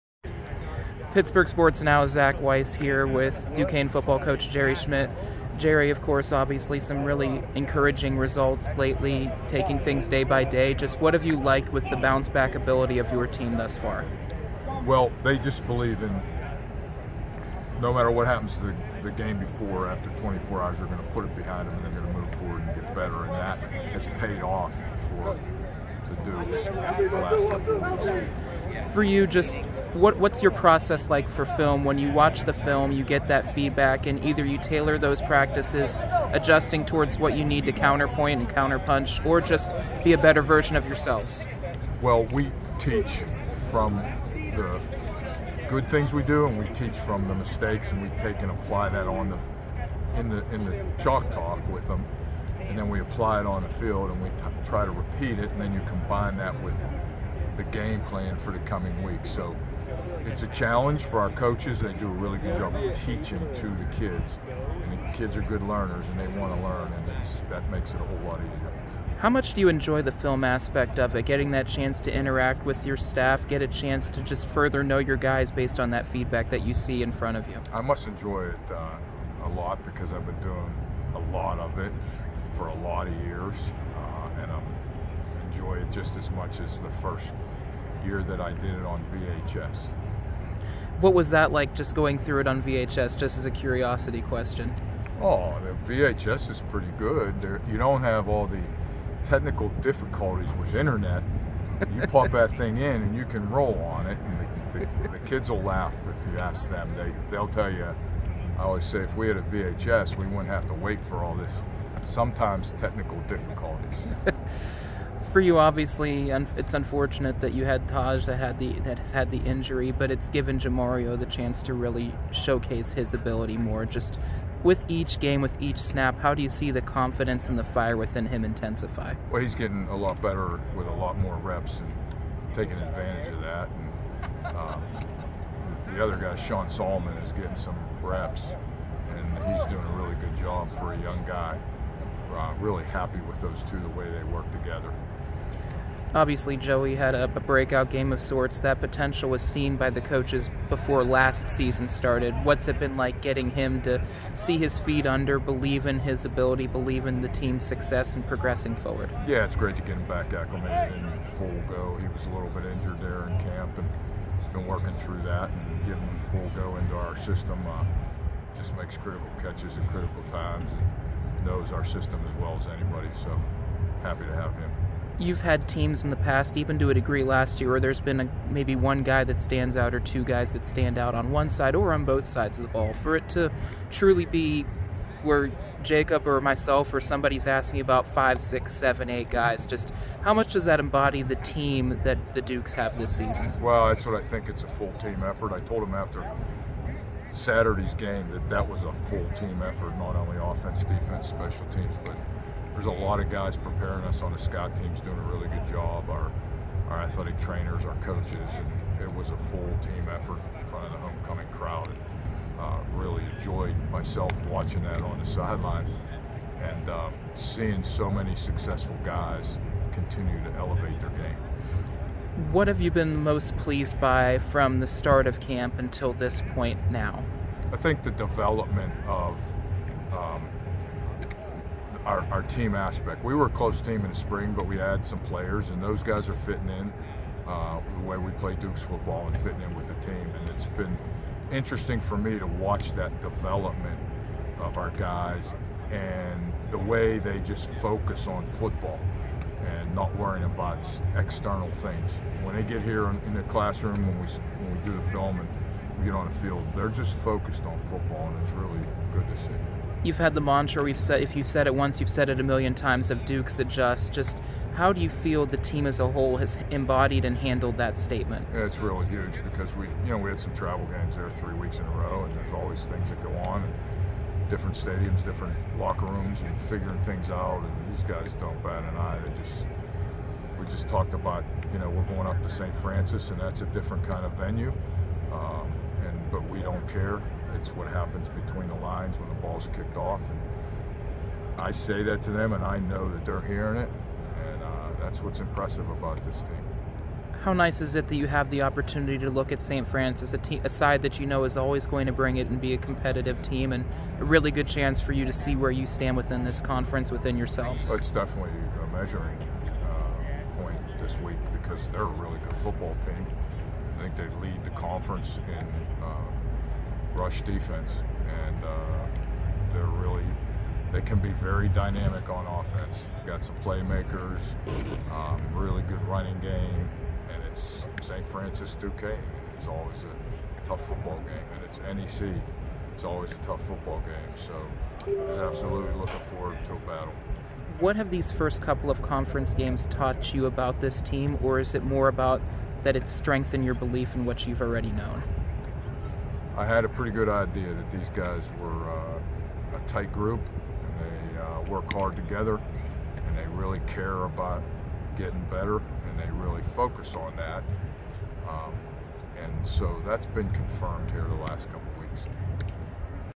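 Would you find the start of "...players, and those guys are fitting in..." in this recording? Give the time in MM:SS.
03:55.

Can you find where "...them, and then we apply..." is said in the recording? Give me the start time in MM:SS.
00:51.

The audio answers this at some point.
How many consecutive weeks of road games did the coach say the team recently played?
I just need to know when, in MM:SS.
04:31.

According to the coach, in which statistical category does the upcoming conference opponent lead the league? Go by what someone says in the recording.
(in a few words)
Rush defense.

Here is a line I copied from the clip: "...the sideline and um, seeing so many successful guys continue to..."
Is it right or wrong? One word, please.
right.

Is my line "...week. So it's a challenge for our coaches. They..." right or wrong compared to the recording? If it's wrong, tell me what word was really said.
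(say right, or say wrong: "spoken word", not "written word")
right.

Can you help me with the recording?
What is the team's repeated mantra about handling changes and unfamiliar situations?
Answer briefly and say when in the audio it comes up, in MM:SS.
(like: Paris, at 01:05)
Dukes adjust, at 04:23.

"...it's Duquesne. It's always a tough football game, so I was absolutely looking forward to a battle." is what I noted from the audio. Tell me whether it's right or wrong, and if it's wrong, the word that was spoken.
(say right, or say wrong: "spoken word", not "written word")
wrong: "NEC", not "Duquesne".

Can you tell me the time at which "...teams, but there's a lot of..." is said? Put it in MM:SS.
03:21.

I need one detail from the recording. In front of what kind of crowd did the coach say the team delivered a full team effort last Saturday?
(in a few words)
Homecoming crowd.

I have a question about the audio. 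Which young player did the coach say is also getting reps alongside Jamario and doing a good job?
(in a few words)
Sean Solomon.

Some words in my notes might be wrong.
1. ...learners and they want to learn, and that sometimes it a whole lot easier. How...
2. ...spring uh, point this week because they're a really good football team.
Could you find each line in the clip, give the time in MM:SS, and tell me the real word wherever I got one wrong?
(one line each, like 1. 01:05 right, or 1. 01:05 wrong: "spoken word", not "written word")
1. 01:05 wrong: "makes", not "sometimes"
2. 05:08 wrong: "measuring", not "spring".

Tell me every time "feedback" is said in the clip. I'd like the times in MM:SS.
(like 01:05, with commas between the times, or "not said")
00:33, 01:16.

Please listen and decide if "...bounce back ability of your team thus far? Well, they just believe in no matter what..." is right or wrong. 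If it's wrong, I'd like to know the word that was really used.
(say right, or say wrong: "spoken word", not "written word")
right.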